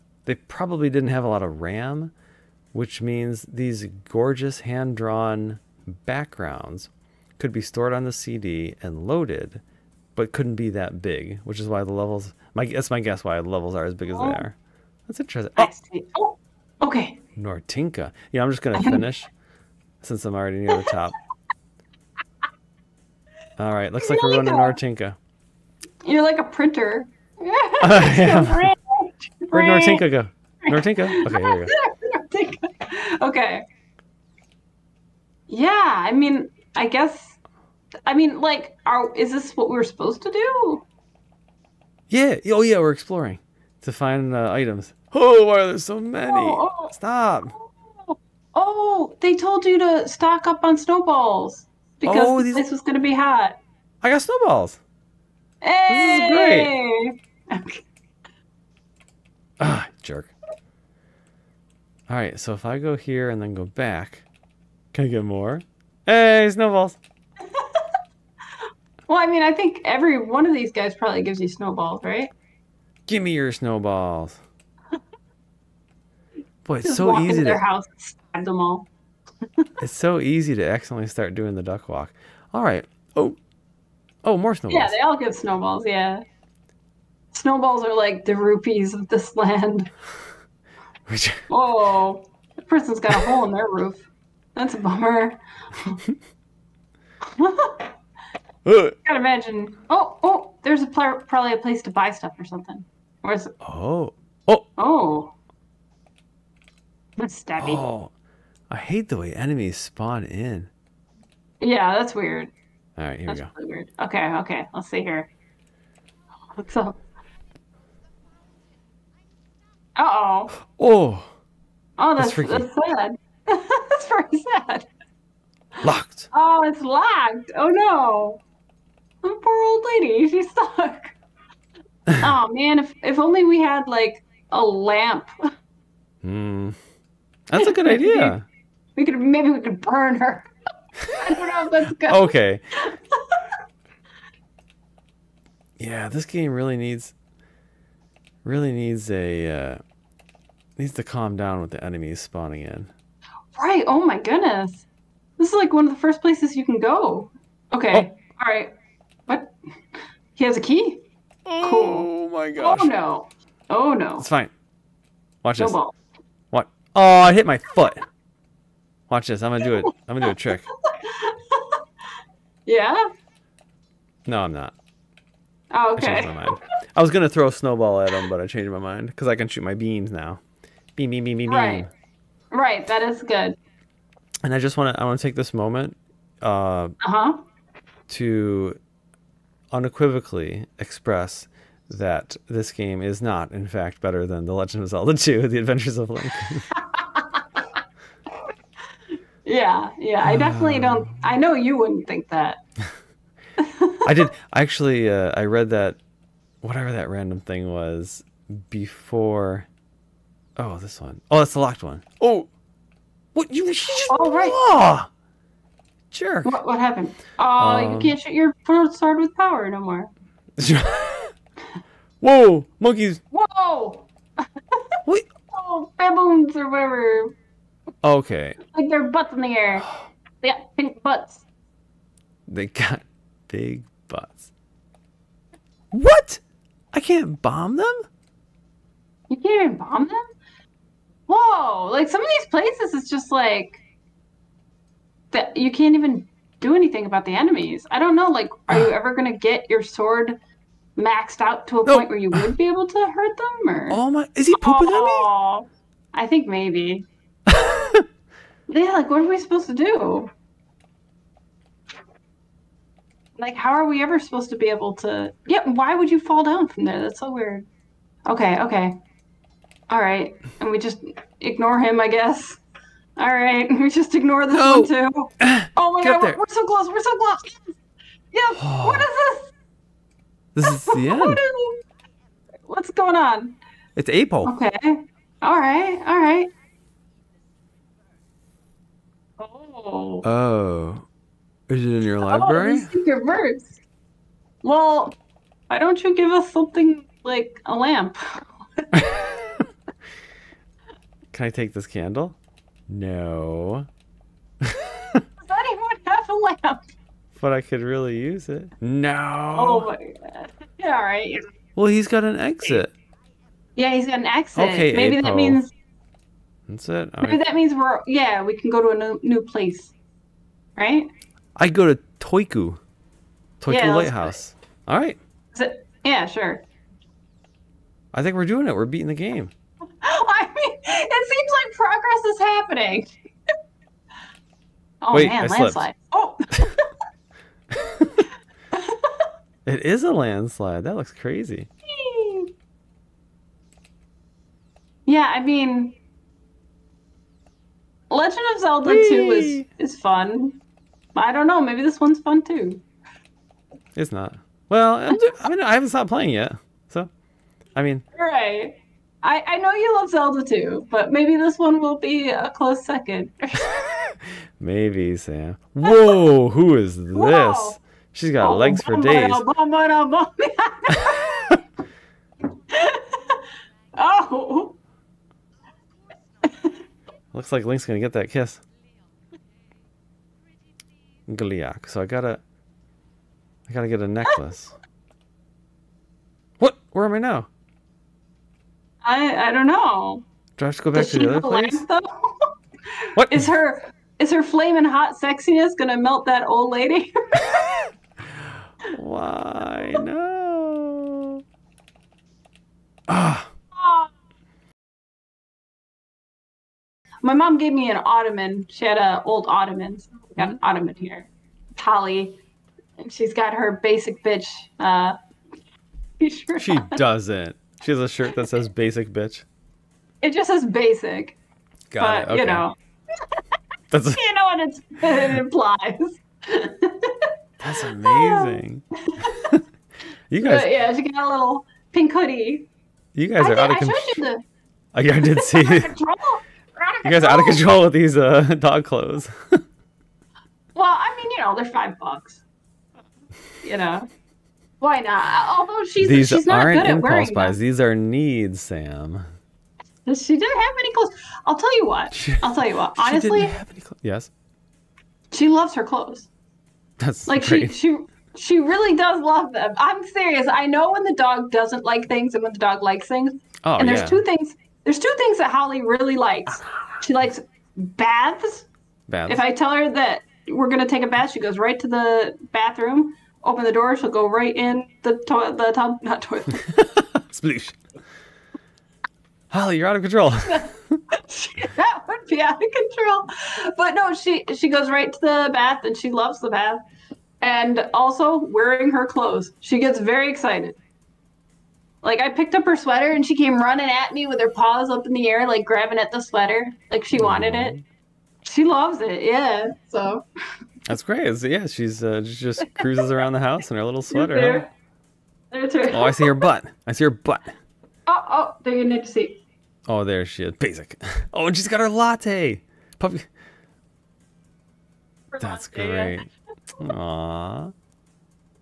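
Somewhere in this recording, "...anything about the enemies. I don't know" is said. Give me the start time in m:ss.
4:06.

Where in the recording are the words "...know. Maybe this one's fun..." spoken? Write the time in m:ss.
5:51.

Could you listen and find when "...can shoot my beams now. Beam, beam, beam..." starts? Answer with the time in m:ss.
2:59.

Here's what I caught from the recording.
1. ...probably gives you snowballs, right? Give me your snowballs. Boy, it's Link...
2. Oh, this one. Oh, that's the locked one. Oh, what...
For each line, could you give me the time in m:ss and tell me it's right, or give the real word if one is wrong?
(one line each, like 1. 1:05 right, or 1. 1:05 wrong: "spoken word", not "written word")
1. 1:10 wrong: "Just", not "Link"
2. 3:30 right.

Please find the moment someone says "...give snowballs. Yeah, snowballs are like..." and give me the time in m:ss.
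1:25.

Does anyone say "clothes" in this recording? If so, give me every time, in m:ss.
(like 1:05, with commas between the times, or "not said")
7:18, 7:30, 7:35, 8:09.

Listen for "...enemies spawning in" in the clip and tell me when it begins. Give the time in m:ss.
2:31.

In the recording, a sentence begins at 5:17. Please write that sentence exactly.
that means we're yeah, we can go to a new, new place, right?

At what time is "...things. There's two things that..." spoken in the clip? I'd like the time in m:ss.
7:44.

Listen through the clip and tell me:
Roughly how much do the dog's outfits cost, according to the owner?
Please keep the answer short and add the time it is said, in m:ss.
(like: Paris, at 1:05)
5 dollars, at 7:21.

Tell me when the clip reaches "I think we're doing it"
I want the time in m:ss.
5:28.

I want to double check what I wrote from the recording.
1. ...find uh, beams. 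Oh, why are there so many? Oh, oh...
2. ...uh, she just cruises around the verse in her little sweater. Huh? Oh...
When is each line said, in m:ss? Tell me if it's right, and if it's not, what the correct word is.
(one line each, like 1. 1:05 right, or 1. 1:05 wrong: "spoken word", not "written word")
1. 0:43 wrong: "items", not "beams"
2. 8:22 wrong: "house", not "verse".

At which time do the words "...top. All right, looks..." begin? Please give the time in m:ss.
0:20.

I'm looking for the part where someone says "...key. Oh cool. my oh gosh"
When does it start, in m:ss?
2:40.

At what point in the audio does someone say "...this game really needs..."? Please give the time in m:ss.
2:26.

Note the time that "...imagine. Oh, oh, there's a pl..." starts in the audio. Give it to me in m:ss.
1:39.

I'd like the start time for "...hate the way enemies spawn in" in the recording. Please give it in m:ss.
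1:48.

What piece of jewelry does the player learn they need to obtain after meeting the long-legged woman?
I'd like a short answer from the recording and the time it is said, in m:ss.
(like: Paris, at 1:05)
A necklace, at 6:24.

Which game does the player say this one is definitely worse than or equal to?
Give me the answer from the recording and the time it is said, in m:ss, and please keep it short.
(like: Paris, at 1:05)
Zelda 2: The Adventures of Link, at 3:14.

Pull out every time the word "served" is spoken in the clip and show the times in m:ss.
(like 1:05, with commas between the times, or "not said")
not said.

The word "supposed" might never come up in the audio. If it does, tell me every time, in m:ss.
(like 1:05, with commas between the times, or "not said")
0:39, 4:19, 4:24.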